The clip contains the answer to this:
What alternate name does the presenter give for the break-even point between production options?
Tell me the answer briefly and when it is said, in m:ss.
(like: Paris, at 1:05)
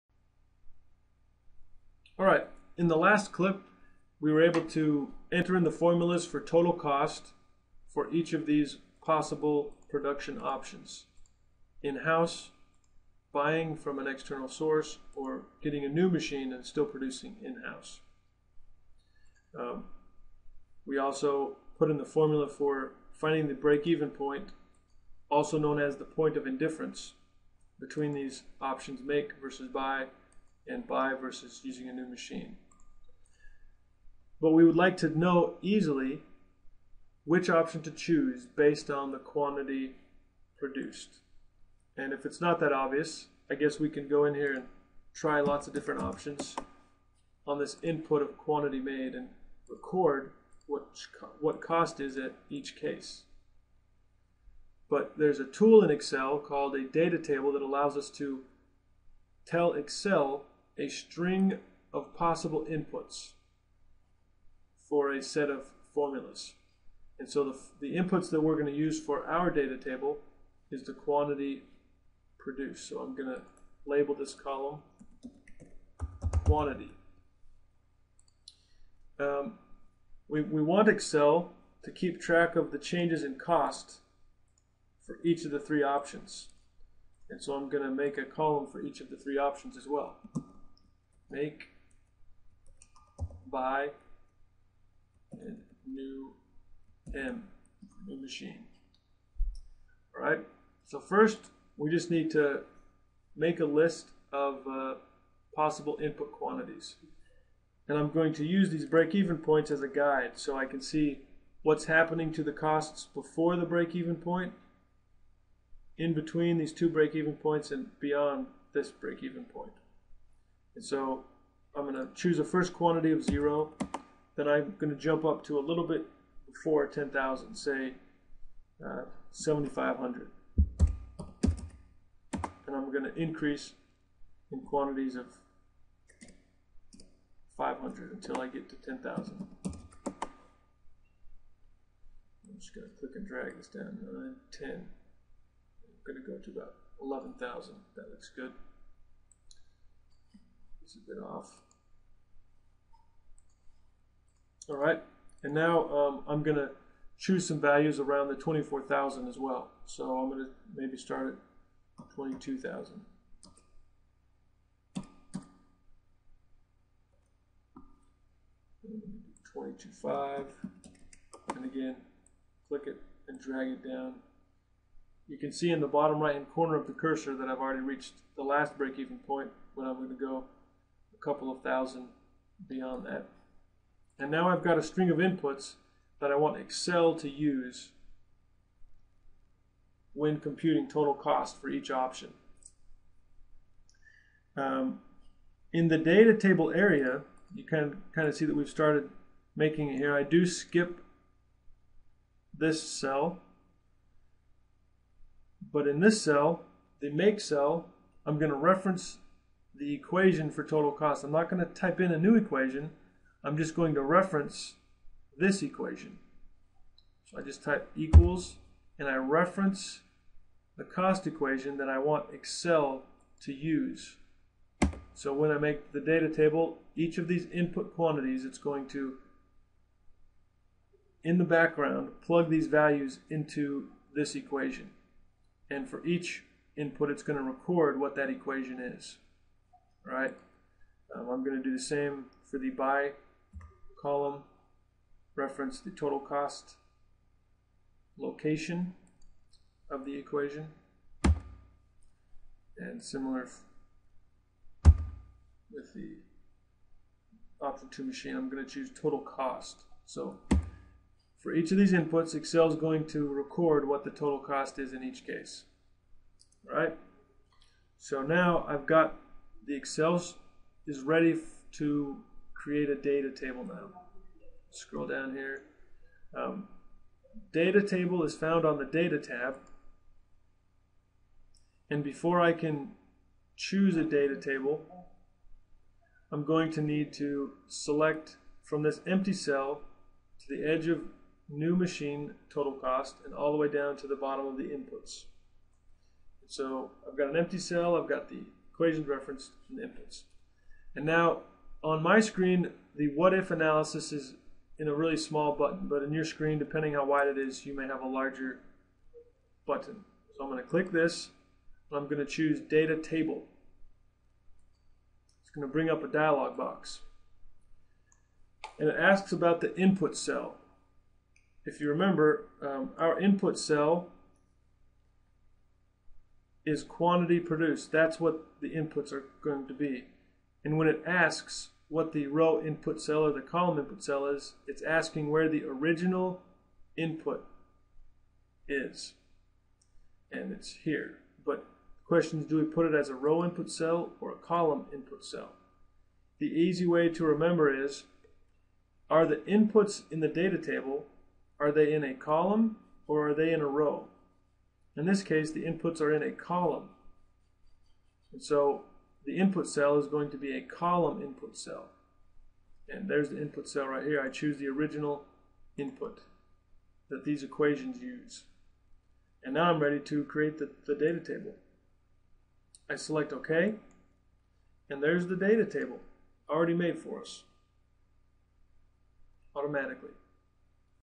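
Point of indifference, at 0:26.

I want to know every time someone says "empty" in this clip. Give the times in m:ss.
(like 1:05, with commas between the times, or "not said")
4:49, 4:57.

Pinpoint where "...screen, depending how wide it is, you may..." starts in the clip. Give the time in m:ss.
5:06.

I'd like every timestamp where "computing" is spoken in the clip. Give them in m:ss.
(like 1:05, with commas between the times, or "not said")
3:10.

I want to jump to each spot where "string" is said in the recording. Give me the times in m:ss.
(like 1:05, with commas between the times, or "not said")
1:00, 3:04.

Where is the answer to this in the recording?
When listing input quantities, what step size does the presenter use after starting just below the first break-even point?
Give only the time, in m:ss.
2:17.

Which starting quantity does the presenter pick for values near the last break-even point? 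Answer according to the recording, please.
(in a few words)
22,000.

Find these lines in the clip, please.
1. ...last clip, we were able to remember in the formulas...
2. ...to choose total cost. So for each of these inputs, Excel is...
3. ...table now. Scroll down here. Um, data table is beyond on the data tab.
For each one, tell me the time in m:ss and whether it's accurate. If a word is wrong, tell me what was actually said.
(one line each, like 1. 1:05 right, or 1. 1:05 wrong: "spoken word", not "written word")
1. 0:02 wrong: "enter", not "remember"
2. 4:18 right
3. 4:33 wrong: "found", not "beyond".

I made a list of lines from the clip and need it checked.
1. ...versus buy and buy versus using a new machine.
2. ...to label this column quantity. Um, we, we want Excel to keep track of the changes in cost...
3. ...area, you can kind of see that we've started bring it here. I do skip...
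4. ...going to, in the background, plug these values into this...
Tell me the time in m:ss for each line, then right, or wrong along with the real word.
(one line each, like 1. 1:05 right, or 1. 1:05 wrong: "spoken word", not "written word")
1. 0:29 right
2. 1:13 right
3. 3:16 wrong: "making", not "bring"
4. 3:48 right.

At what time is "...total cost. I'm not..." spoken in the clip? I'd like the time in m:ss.
3:30.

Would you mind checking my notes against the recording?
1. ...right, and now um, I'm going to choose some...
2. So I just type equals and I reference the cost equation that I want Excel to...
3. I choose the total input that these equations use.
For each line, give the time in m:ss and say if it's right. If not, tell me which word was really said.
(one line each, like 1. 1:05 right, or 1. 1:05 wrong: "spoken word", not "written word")
1. 2:34 right
2. 3:37 right
3. 6:04 wrong: "original", not "total".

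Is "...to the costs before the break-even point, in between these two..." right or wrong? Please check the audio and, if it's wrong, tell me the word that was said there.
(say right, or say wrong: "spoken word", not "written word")
right.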